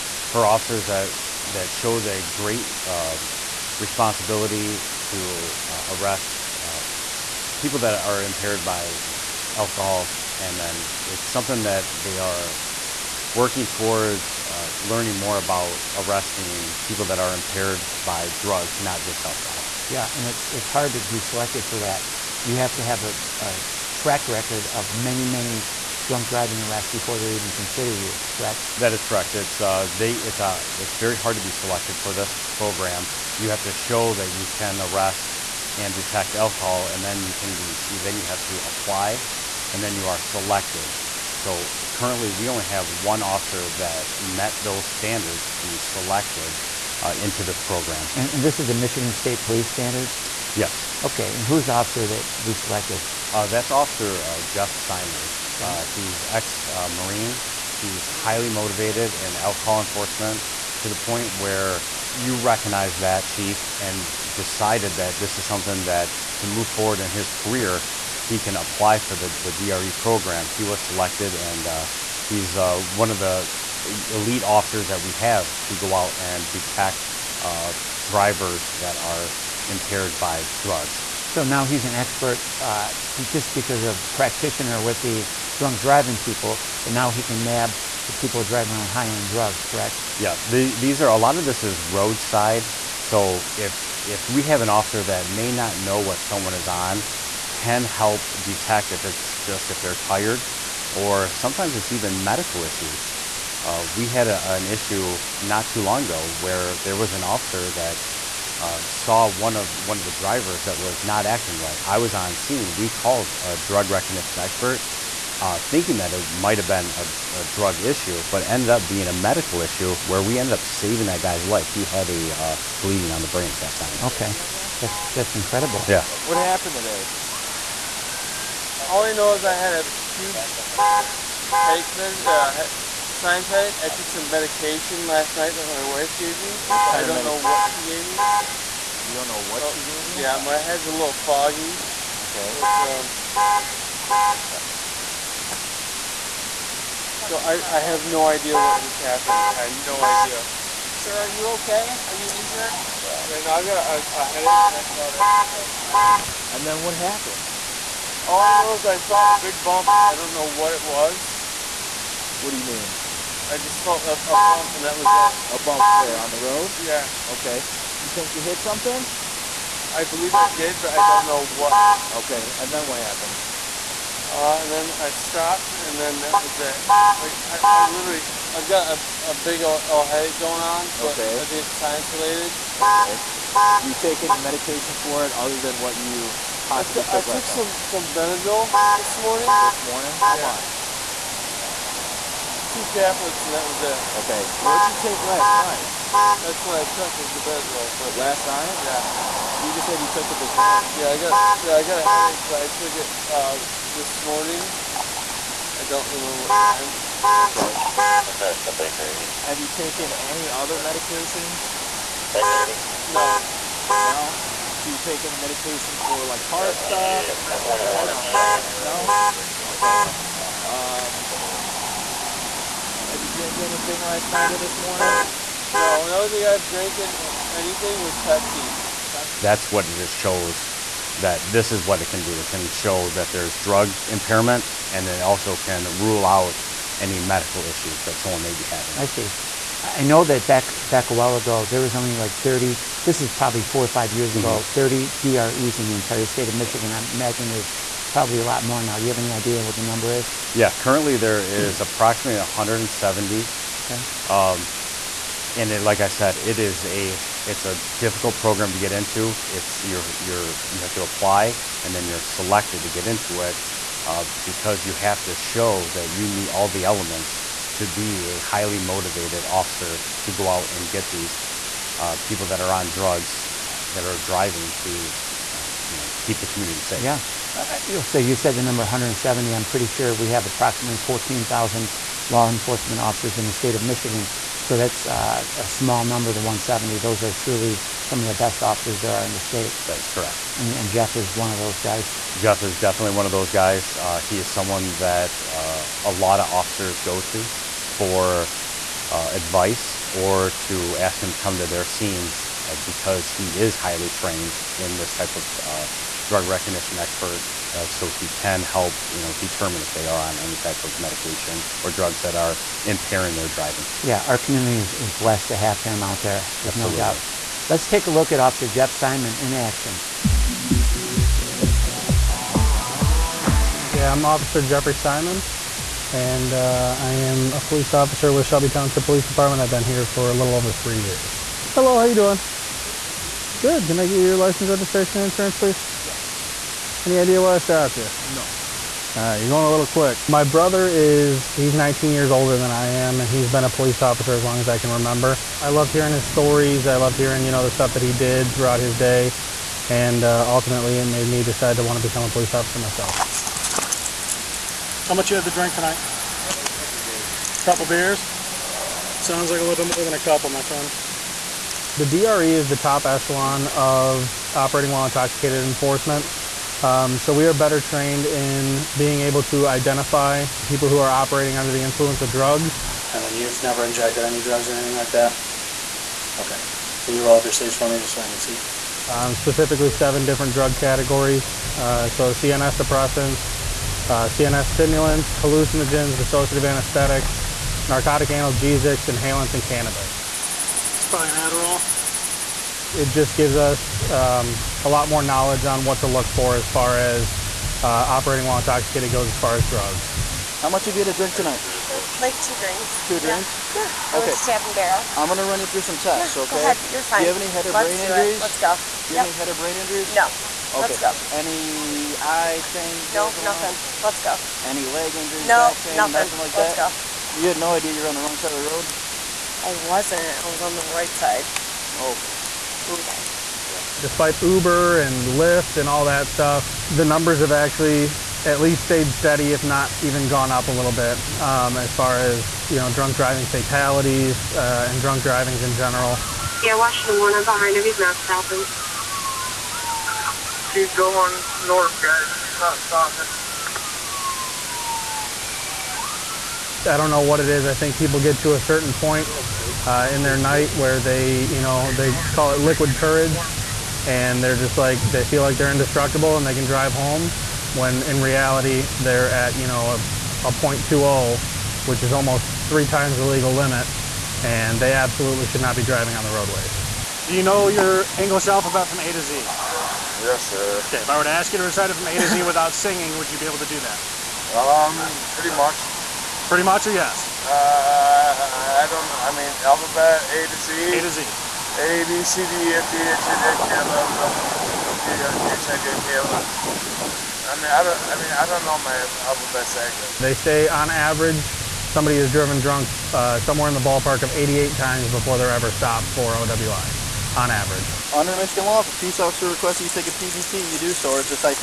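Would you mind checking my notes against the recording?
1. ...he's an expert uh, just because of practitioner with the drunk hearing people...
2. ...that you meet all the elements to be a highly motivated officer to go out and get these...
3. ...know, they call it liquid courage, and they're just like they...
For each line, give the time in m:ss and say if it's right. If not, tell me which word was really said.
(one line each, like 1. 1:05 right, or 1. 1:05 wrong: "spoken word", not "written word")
1. 1:21 wrong: "driving", not "hearing"
2. 4:25 right
3. 7:31 right.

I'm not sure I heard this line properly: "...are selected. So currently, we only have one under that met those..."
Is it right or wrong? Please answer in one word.
wrong.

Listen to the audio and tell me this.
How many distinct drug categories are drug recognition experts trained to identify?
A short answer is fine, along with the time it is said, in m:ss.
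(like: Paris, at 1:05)
7, at 6:19.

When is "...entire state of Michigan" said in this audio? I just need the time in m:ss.
4:05.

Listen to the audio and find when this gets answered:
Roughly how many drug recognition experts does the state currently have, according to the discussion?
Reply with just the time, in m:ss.
4:11.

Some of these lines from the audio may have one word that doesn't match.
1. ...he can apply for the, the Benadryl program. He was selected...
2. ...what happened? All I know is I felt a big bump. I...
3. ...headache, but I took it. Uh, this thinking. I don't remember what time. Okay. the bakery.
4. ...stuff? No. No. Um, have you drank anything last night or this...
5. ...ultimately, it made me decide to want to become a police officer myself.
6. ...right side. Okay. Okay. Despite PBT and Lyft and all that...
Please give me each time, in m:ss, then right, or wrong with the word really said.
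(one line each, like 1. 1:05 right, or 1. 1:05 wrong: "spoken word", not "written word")
1. 1:08 wrong: "DRE", not "Benadryl"
2. 2:36 right
3. 3:22 wrong: "morning", not "thinking"
4. 3:36 right
5. 5:50 right
6. 7:00 wrong: "Uber", not "PBT".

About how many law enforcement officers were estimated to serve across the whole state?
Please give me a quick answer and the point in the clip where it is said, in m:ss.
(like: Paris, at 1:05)
14,000, at 4:41.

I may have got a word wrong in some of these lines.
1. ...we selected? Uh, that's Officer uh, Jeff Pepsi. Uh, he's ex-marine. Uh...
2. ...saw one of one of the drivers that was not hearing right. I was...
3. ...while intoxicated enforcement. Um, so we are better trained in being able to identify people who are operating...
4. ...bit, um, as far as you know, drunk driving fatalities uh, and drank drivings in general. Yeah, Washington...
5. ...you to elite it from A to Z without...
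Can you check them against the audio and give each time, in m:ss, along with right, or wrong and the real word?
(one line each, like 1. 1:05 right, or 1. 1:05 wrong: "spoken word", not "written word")
1. 0:52 wrong: "Simon", not "Pepsi"
2. 1:48 wrong: "acting", not "hearing"
3. 6:04 right
4. 7:10 wrong: "drunk", not "drank"
5. 7:51 wrong: "recite", not "elite".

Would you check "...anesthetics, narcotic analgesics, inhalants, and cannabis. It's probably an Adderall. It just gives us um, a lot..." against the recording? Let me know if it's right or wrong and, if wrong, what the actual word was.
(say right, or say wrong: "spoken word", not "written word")
right.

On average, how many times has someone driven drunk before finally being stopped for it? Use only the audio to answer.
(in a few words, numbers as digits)
88.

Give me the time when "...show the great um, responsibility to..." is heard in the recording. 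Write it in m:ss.
0:01.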